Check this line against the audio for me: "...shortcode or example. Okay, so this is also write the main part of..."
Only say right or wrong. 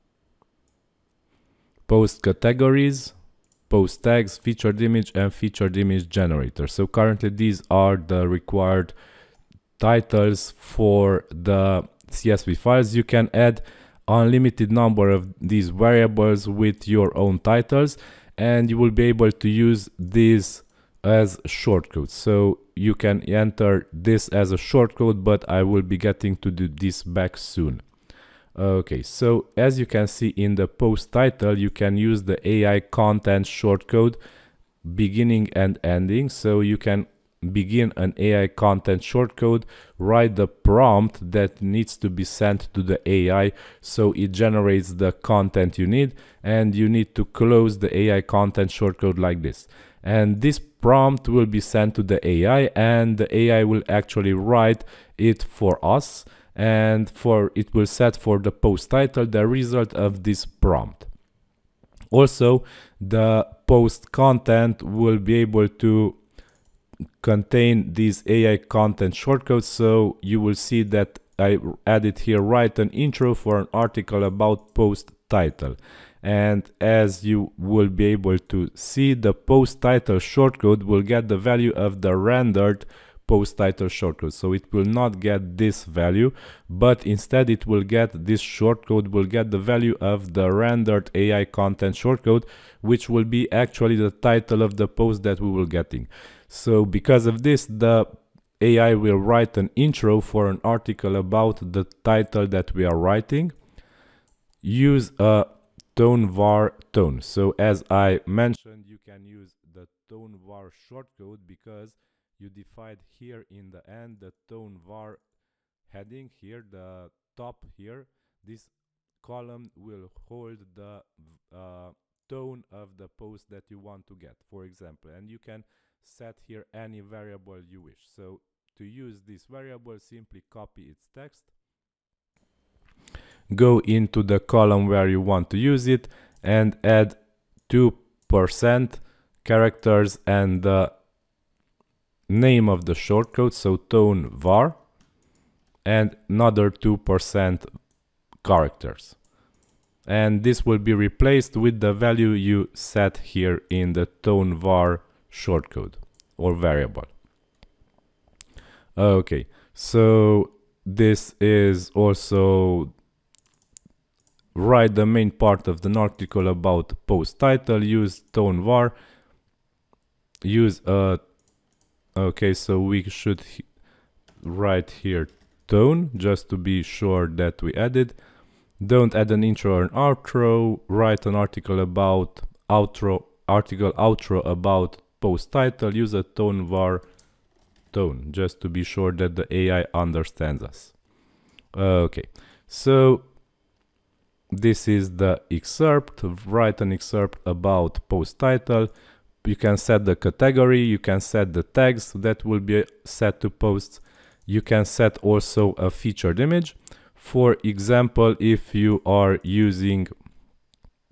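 wrong.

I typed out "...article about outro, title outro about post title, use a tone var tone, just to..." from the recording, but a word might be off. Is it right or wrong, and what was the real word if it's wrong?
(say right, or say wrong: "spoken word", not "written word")
wrong: "article", not "title".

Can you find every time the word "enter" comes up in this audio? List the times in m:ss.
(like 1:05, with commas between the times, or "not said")
0:23.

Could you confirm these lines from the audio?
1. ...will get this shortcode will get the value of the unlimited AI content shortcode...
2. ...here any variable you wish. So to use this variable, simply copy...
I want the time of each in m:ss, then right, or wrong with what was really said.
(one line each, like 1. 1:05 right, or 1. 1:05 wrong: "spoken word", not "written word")
1. 1:27 wrong: "rendered", not "unlimited"
2. 2:06 right.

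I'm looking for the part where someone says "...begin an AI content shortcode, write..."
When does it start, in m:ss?
0:37.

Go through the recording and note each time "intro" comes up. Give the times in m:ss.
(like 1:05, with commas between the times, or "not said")
1:12, 1:39, 2:59.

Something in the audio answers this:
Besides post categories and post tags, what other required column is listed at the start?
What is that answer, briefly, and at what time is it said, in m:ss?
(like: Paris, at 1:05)
featured image generator, at 0:05.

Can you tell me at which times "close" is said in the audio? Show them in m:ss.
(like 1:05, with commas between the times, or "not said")
0:47.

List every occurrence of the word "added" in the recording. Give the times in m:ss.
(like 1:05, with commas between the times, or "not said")
1:11, 2:57.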